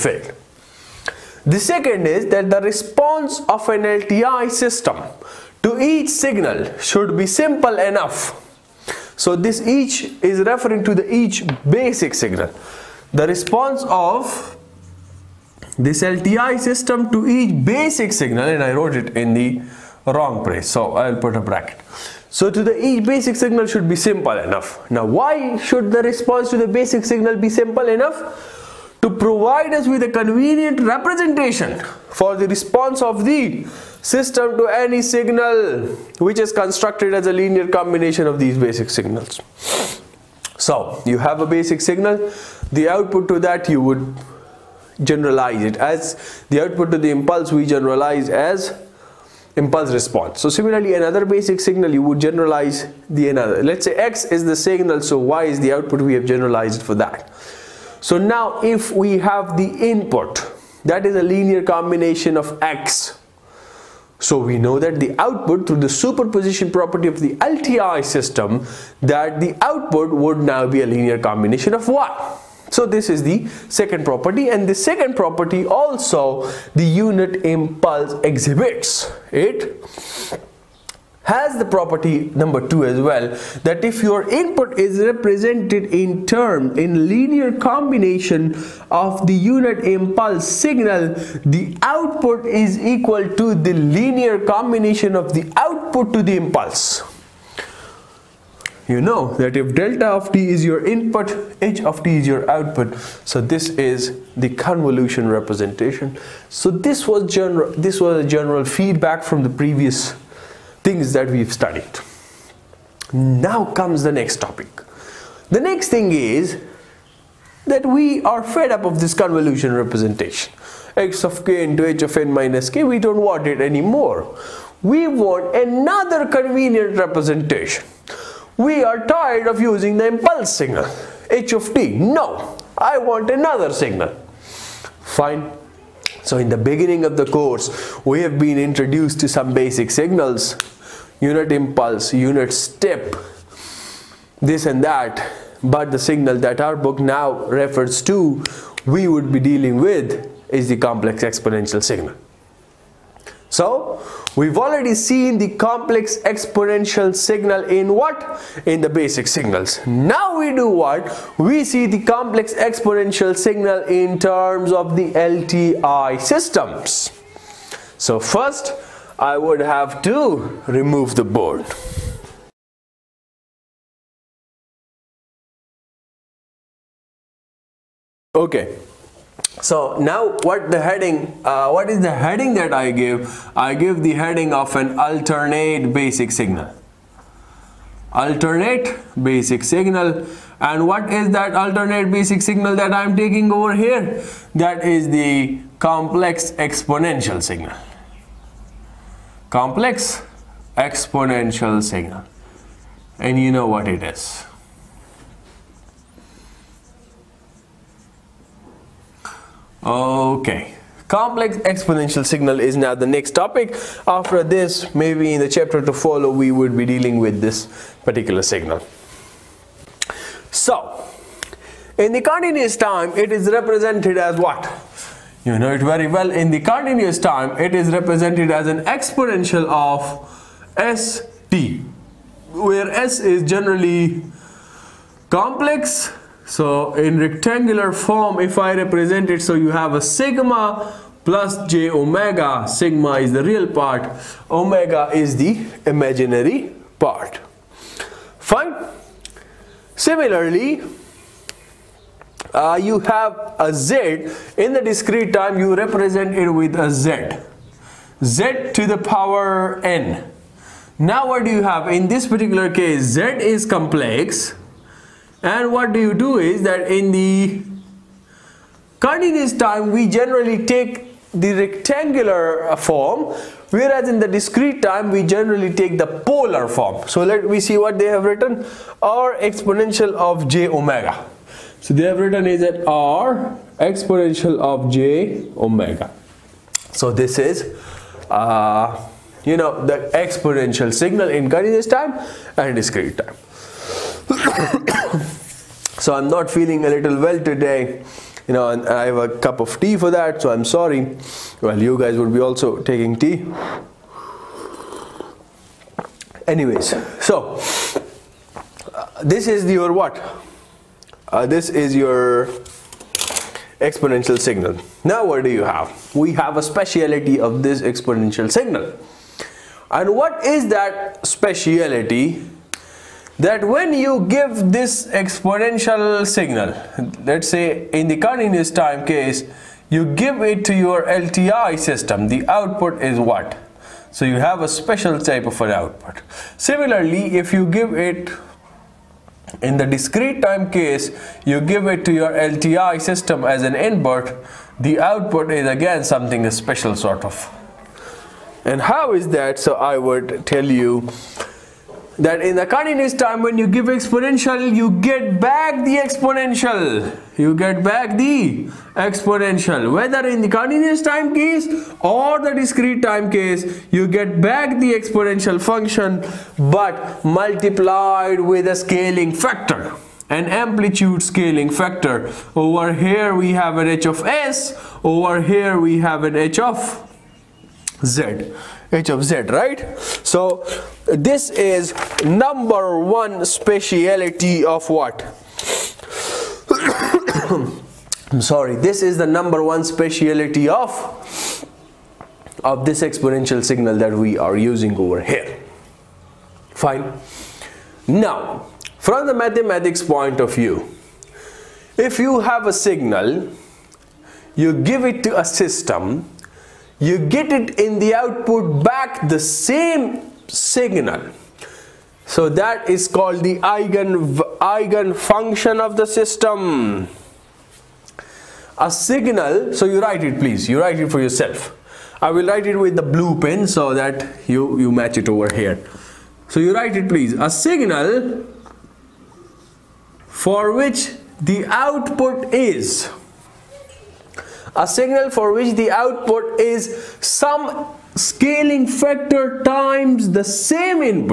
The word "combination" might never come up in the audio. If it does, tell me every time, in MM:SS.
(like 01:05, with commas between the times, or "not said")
00:37, 01:01, 01:11, 01:27, 01:34.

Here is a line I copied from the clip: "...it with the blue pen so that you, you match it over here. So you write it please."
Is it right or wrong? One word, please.
right.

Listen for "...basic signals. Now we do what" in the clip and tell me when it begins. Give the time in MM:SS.
02:38.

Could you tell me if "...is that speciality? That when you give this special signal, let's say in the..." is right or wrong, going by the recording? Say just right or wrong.
wrong.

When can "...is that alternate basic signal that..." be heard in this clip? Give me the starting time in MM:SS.
03:11.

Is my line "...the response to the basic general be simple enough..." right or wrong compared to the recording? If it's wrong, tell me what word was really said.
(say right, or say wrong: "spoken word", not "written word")
wrong: "signal", not "general".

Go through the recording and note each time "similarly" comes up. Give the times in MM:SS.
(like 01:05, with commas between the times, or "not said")
00:50, 04:09, 05:36.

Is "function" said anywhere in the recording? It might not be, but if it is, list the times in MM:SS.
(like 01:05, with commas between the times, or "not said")
06:05, 06:55.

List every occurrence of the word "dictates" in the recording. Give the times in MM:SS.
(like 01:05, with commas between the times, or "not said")
not said.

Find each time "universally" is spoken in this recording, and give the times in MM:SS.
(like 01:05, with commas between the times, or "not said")
not said.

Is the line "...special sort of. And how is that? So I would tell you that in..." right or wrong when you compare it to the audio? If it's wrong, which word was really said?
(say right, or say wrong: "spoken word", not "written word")
right.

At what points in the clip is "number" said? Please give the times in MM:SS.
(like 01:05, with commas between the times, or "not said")
01:22, 06:22, 06:29.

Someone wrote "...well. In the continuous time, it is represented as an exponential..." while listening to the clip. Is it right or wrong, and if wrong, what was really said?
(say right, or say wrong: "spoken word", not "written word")
right.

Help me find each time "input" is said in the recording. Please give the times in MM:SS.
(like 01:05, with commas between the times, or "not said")
00:59, 01:24, 01:40, 05:43.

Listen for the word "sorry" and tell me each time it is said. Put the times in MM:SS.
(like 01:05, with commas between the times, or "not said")
05:00, 06:28.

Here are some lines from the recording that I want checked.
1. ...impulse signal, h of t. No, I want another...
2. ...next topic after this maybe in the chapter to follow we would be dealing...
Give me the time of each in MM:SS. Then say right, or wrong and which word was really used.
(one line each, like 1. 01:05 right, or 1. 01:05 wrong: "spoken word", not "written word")
1. 02:10 right
2. 03:33 right.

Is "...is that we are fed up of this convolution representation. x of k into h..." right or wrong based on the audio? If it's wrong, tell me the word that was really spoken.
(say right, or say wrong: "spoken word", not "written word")
right.